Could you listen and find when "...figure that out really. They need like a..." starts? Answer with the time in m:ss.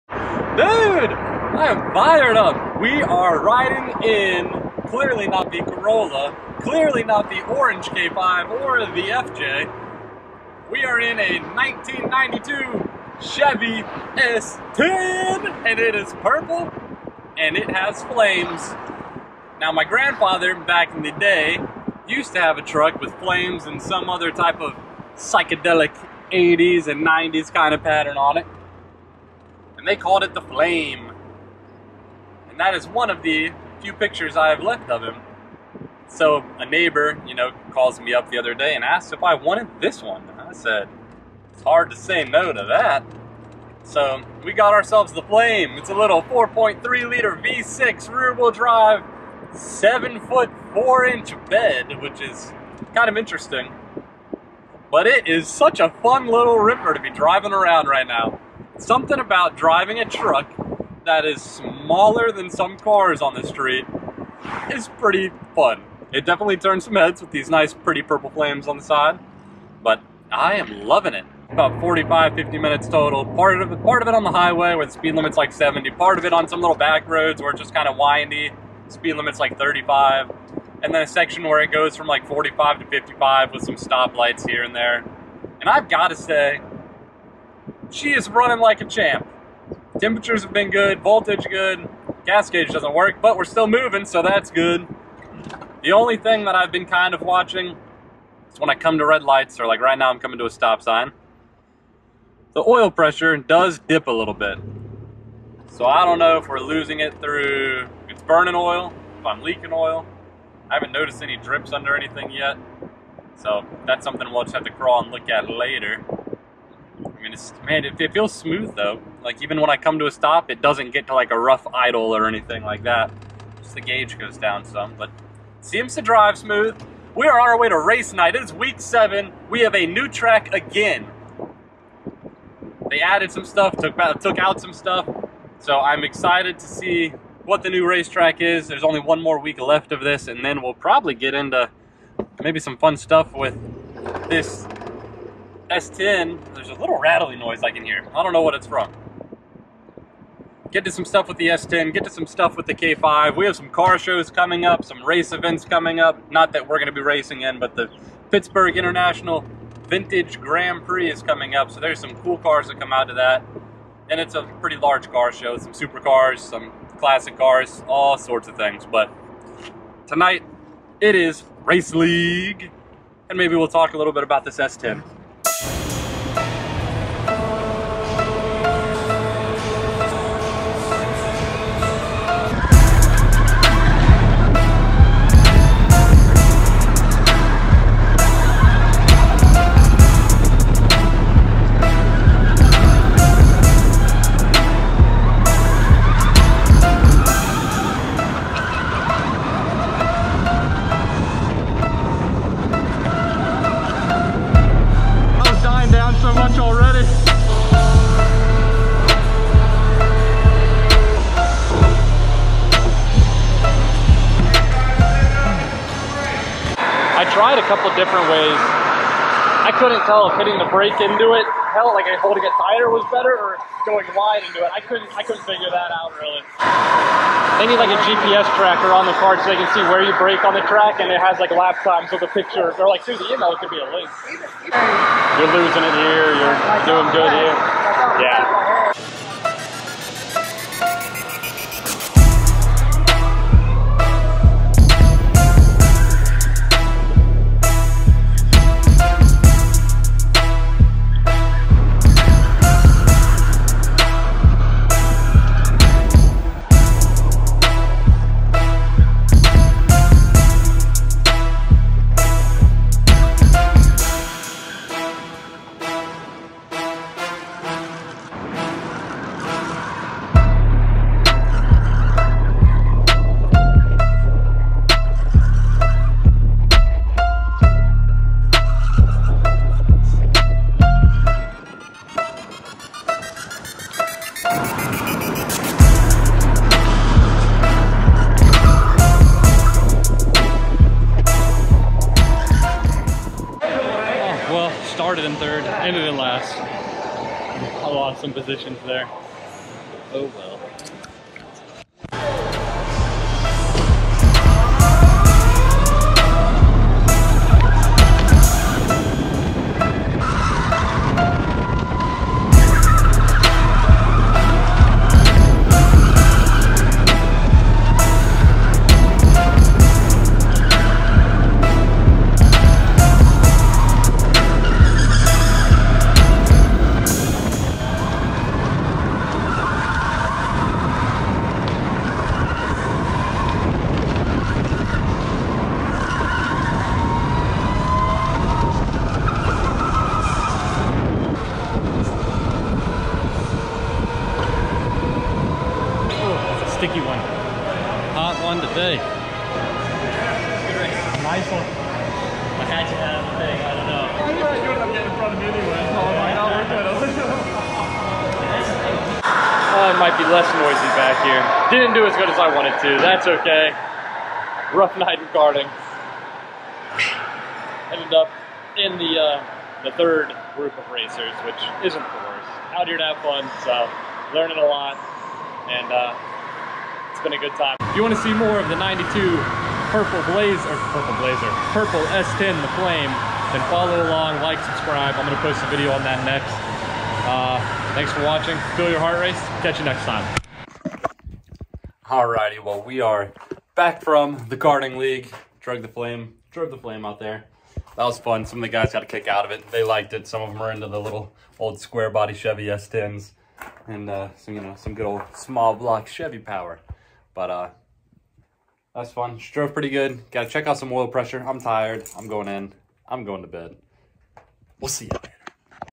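3:45.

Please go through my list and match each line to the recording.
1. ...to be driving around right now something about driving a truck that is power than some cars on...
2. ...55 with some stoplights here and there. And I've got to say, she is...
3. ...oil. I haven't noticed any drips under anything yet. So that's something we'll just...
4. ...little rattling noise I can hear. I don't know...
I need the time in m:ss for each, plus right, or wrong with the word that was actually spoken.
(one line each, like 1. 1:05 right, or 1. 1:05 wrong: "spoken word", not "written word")
1. 0:56 wrong: "smaller", not "power"
2. 1:22 right
3. 1:49 right
4. 2:26 right.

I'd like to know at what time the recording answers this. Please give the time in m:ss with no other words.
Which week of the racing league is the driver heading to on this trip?
2:08.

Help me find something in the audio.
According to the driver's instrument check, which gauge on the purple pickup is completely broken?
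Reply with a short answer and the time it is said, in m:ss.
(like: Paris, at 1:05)
Gas gauge, at 1:32.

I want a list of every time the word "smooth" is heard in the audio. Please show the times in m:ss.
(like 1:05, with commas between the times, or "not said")
1:58, 2:06.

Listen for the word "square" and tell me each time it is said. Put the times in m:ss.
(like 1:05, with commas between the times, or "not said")
6:41.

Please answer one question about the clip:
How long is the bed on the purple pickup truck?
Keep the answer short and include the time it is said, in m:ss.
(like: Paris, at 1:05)
seven foot four inch, at 0:49.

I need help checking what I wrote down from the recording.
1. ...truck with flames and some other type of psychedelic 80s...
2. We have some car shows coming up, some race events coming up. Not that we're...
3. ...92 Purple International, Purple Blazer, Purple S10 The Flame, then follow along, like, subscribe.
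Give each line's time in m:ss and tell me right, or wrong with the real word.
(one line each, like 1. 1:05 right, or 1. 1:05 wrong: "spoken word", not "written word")
1. 0:22 right
2. 2:33 right
3. 6:18 wrong: "Blazer", not "International".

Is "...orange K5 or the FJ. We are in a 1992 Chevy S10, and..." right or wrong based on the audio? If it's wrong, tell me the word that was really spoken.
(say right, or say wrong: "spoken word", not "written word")
right.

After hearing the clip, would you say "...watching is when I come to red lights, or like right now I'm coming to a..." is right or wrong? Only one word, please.
right.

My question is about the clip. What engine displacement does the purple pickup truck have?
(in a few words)
4.3 liter.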